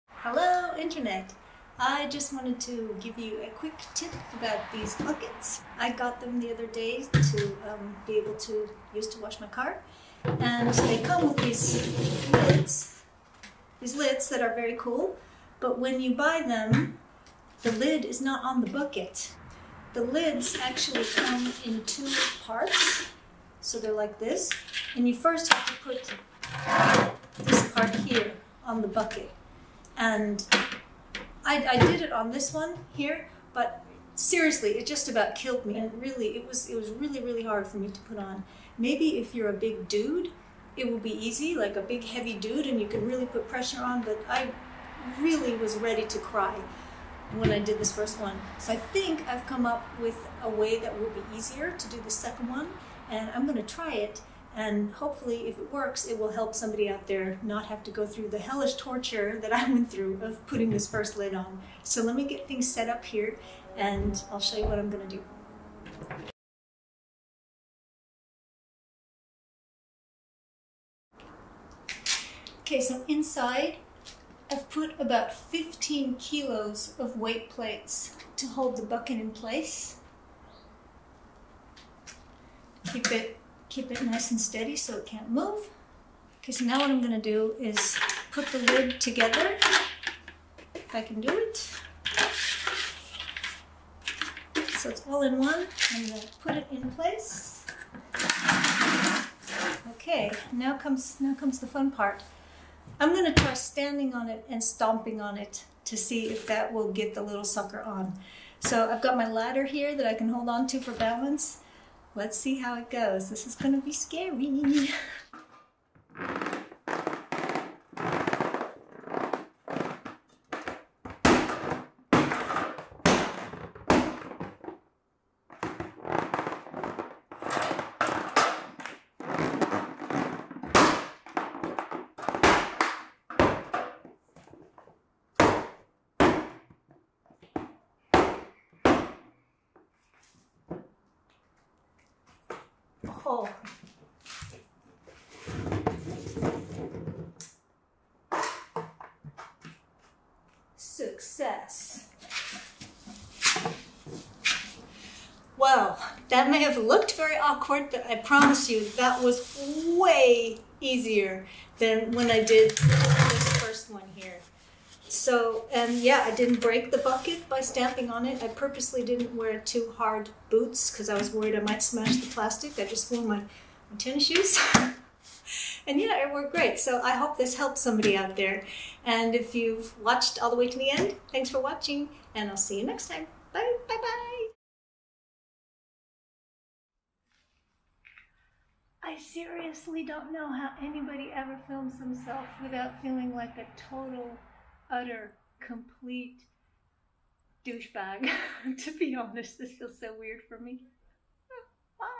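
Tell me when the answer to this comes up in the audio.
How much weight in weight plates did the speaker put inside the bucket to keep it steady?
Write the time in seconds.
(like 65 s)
75 s.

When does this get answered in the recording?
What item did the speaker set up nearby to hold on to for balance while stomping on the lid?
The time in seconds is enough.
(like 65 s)
109 s.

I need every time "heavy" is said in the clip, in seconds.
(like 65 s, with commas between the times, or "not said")
42 s.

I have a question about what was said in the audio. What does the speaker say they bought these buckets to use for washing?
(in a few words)
Car.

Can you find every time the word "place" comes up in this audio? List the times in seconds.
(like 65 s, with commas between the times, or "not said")
79 s, 96 s.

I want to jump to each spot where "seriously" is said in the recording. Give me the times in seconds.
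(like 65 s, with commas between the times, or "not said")
34 s, 189 s.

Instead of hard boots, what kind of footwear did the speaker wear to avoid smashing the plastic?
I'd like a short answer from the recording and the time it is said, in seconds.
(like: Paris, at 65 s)
Tennis shoes, at 173 s.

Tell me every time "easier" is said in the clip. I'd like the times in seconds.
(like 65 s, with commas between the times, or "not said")
51 s, 160 s.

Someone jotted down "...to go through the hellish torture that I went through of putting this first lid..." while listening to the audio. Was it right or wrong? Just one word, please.
right.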